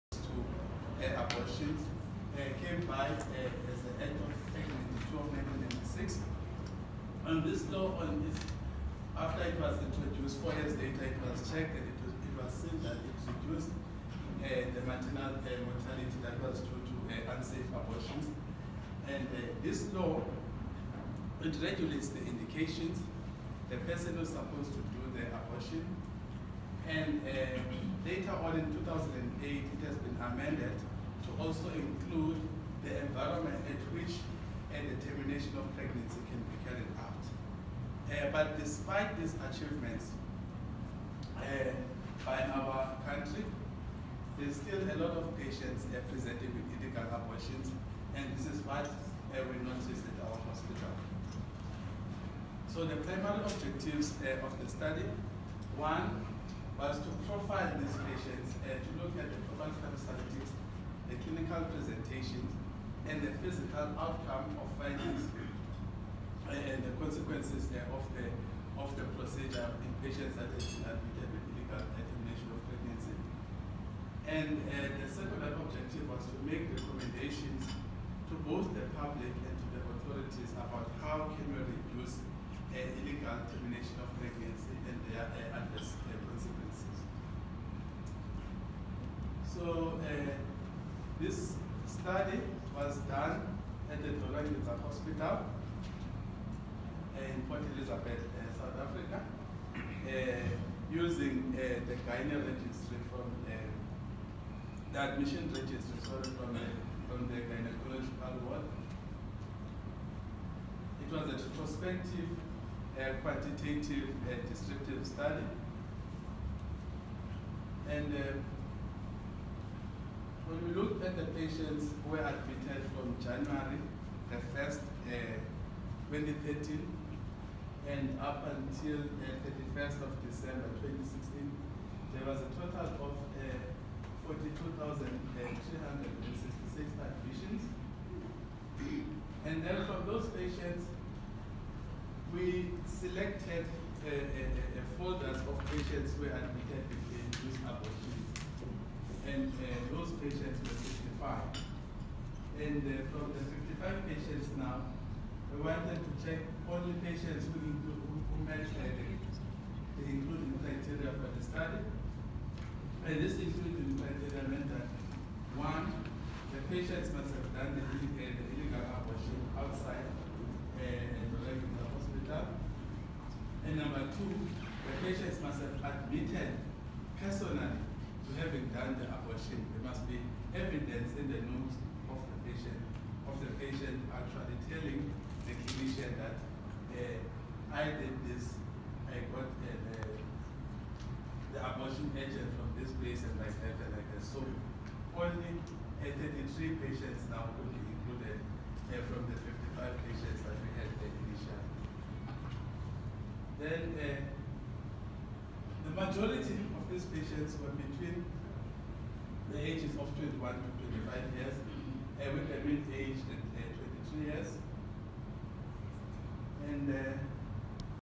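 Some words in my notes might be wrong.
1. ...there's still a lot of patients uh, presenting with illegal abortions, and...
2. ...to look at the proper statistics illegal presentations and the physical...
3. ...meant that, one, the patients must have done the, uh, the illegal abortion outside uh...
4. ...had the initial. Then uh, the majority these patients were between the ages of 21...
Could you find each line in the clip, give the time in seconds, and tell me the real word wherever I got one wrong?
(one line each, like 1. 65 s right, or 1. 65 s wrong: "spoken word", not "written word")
1. 44 s right
2. 58 s wrong: "clinical", not "illegal"
3. 164 s right
4. 200 s right.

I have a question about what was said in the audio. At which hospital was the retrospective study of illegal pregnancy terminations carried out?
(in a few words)
Dora Nginza Hospital.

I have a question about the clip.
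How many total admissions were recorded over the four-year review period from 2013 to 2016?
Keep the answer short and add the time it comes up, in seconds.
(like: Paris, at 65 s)
42,366, at 134 s.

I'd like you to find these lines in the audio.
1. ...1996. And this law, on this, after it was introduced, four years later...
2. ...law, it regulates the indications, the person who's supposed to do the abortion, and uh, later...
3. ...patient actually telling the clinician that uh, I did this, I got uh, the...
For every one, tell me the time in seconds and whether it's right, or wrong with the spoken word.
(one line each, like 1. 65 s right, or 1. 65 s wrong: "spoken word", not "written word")
1. 5 s right
2. 19 s right
3. 183 s right.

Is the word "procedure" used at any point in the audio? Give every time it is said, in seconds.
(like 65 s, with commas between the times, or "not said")
69 s.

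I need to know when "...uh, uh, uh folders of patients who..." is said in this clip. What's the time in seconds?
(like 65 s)
144 s.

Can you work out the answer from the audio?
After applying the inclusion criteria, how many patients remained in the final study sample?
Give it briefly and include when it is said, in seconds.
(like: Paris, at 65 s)
33, at 196 s.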